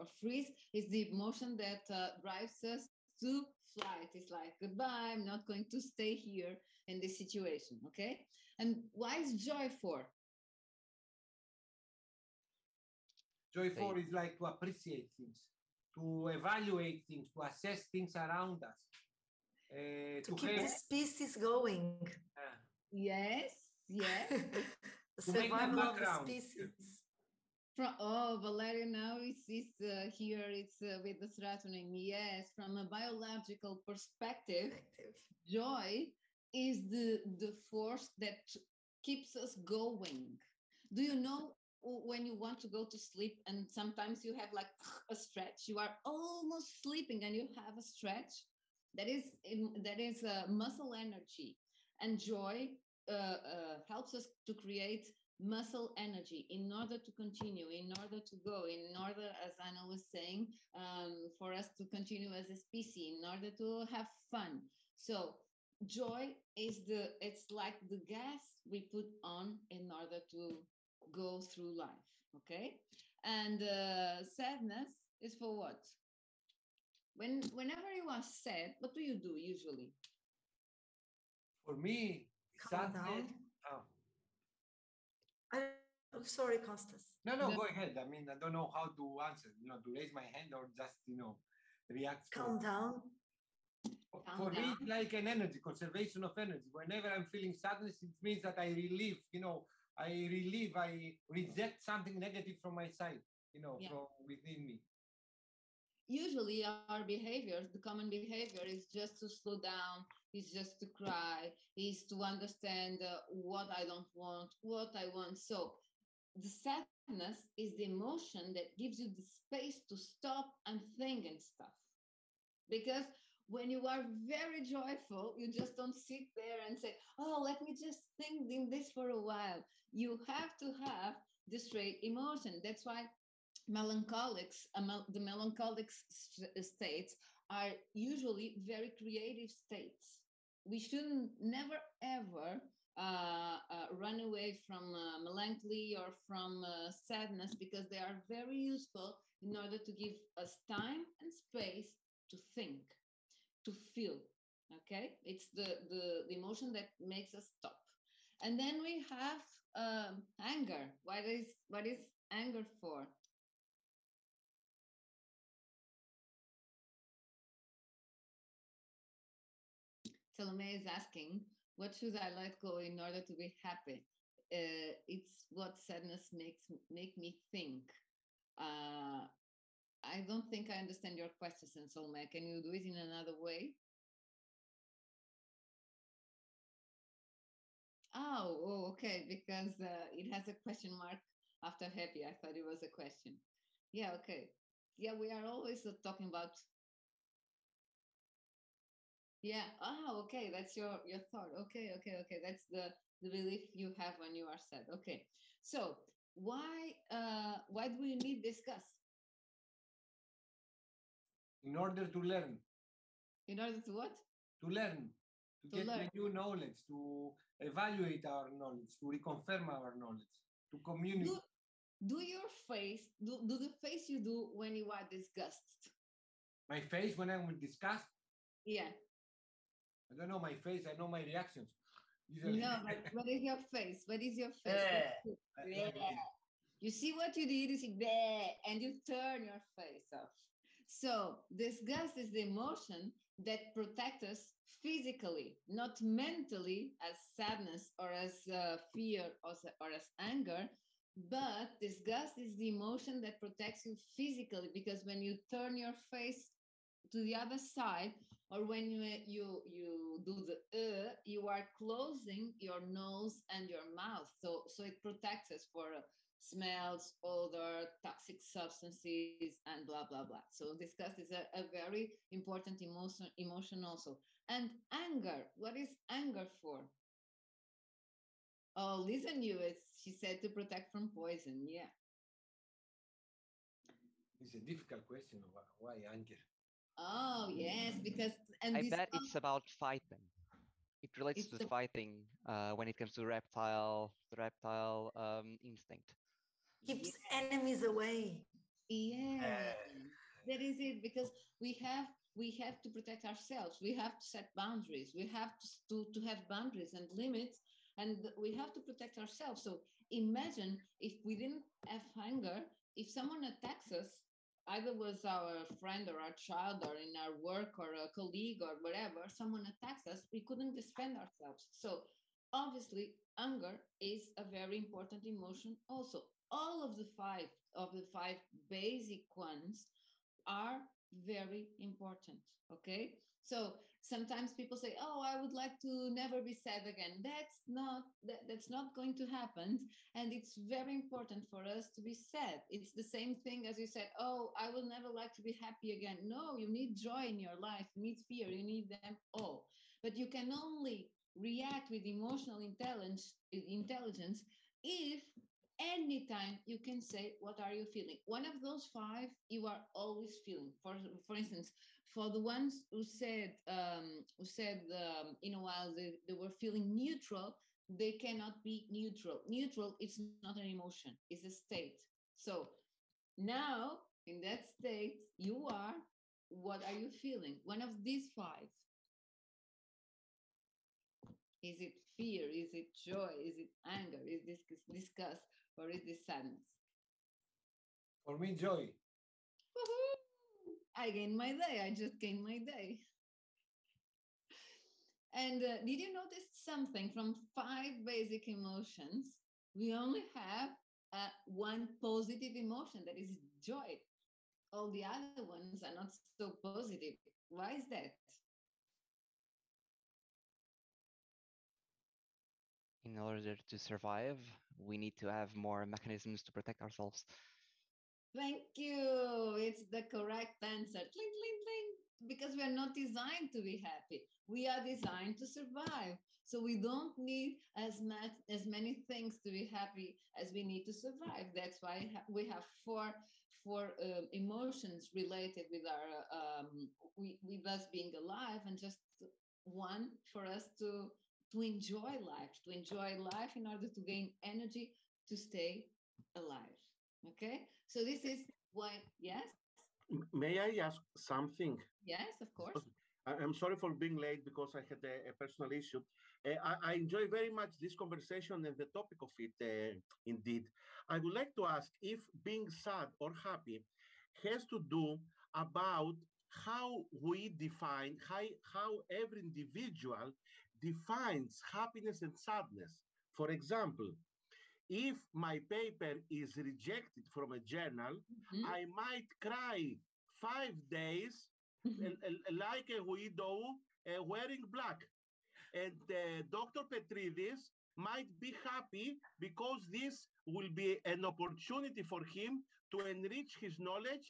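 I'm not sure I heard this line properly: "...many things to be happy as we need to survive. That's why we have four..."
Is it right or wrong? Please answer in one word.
right.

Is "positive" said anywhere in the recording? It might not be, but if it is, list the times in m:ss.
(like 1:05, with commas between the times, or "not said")
6:41, 6:46.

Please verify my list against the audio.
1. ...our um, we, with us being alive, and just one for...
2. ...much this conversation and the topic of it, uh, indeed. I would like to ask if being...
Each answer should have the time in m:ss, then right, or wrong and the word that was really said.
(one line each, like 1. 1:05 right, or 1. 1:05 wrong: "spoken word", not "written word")
1. 7:15 right
2. 7:37 right.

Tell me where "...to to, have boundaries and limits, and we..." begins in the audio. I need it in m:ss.
5:05.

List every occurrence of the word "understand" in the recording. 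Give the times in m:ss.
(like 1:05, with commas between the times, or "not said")
1:52, 3:00.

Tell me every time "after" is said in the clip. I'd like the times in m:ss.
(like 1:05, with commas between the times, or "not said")
3:11.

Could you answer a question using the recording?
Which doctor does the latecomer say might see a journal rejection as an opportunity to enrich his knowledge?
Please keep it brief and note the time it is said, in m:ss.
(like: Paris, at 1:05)
Dr. Petridis, at 8:06.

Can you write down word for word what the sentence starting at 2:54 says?
Uh, it's what sadness makes make me think.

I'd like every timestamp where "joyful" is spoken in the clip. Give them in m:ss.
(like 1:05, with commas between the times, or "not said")
0:13, 2:04.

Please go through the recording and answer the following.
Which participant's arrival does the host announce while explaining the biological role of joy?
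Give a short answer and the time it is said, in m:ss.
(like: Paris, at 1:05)
Valeria, at 0:28.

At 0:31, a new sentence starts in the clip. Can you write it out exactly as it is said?
Yes, from a biological perspective, joy is the, the force that keeps us going.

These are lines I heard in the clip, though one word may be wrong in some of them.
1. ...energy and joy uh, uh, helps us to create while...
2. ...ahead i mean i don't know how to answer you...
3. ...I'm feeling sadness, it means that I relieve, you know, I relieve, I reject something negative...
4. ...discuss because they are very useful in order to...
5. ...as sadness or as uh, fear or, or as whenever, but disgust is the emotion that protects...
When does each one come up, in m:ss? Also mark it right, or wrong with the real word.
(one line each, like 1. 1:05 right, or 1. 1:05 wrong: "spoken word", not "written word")
1. 0:50 wrong: "muscle", not "while"
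2. 1:27 right
3. 1:37 right
4. 2:26 wrong: "sadness", not "discuss"
5. 4:06 wrong: "anger", not "whenever".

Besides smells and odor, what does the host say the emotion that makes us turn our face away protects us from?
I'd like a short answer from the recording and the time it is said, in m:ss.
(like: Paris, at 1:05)
Toxic substances, at 4:28.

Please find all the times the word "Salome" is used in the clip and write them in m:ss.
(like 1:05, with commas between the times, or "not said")
2:50, 3:01.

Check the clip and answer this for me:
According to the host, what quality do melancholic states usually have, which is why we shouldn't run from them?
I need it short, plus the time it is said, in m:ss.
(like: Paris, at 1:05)
Creative, at 2:18.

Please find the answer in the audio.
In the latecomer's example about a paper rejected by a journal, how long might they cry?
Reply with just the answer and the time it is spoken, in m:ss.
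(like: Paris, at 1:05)
5 days, at 8:00.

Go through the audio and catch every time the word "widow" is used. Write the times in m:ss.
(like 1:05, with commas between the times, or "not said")
8:03.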